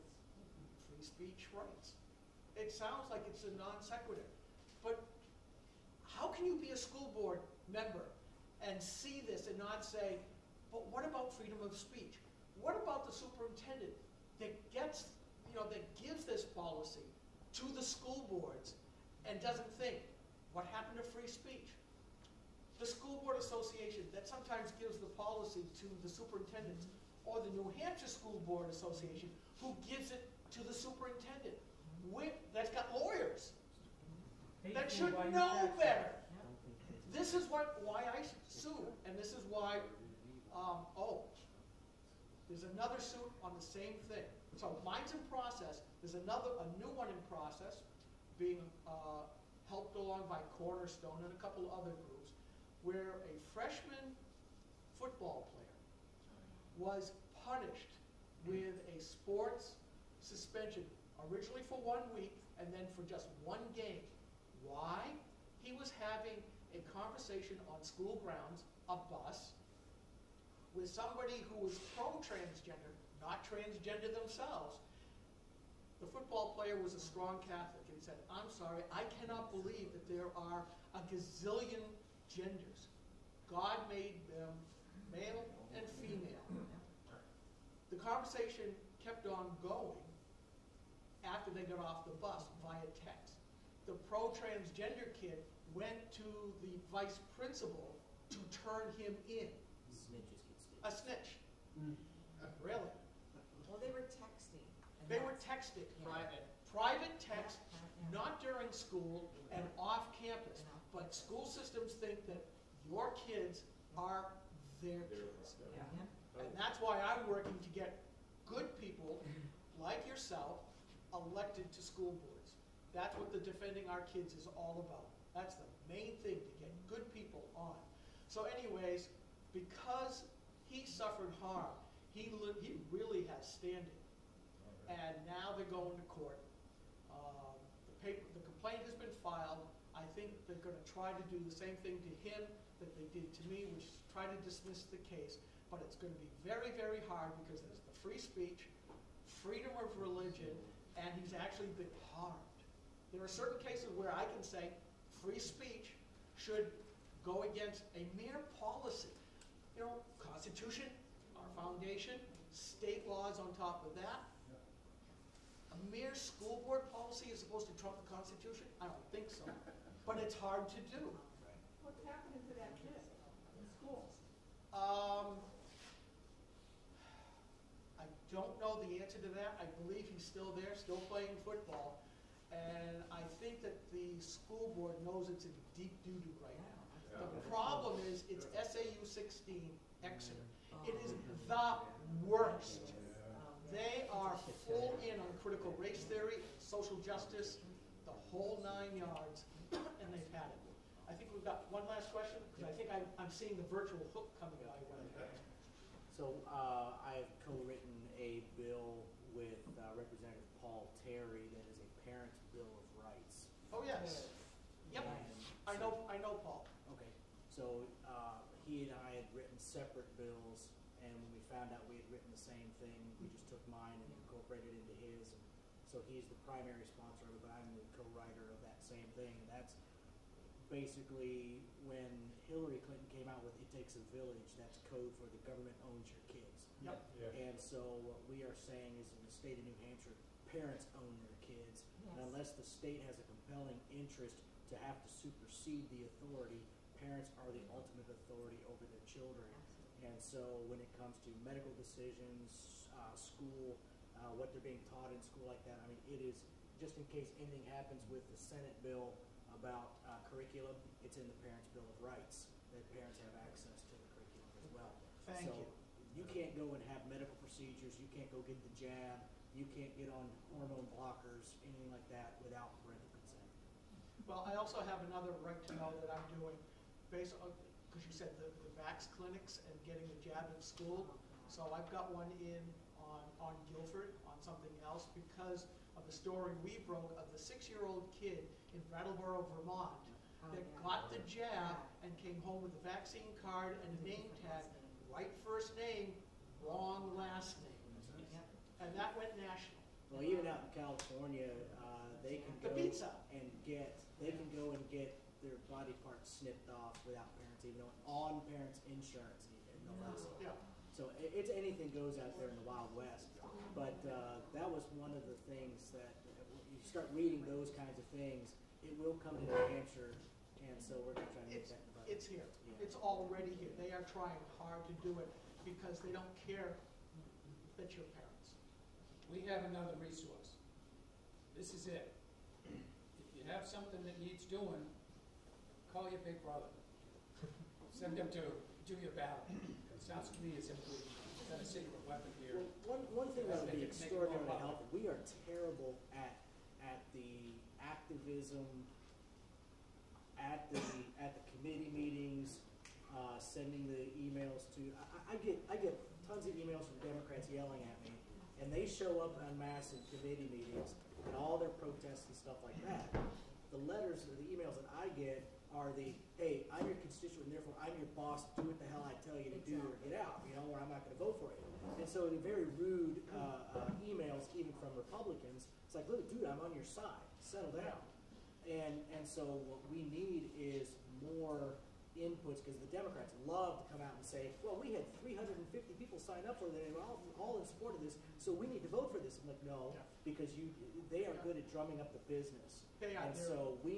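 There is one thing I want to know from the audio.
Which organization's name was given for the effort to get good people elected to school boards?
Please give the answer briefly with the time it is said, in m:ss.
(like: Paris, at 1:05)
Defending Our Kids, at 2:03.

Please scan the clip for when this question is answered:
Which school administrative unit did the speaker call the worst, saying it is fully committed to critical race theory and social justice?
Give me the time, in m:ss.
3:08.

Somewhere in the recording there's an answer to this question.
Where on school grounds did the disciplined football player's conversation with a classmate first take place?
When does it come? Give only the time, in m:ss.
1:08.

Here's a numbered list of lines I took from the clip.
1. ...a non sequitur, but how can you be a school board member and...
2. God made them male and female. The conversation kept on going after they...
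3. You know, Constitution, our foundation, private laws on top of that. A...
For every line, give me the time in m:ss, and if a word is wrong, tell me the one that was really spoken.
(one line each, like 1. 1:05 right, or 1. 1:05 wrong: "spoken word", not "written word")
1. 0:03 right
2. 1:23 right
3. 2:39 wrong: "state", not "private".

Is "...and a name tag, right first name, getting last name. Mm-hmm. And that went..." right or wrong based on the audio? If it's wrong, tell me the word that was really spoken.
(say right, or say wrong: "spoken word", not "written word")
wrong: "wrong", not "getting".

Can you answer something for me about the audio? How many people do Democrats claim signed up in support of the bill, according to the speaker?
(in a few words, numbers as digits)
350.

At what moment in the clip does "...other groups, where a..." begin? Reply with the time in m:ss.
0:51.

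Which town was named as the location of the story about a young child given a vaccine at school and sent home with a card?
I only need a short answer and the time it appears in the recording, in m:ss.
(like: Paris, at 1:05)
Brattleboro, Vermont, at 4:48.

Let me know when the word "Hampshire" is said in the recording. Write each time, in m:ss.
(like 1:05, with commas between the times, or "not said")
0:27, 3:59, 5:19.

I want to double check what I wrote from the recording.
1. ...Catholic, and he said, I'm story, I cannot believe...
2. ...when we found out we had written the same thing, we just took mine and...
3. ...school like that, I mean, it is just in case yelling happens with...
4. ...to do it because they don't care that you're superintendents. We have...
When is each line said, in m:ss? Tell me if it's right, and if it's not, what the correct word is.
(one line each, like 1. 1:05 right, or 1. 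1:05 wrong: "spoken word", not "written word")
1. 1:17 wrong: "sorry", not "story"
2. 3:41 right
3. 4:15 wrong: "anything", not "yelling"
4. 5:24 wrong: "parents", not "superintendents".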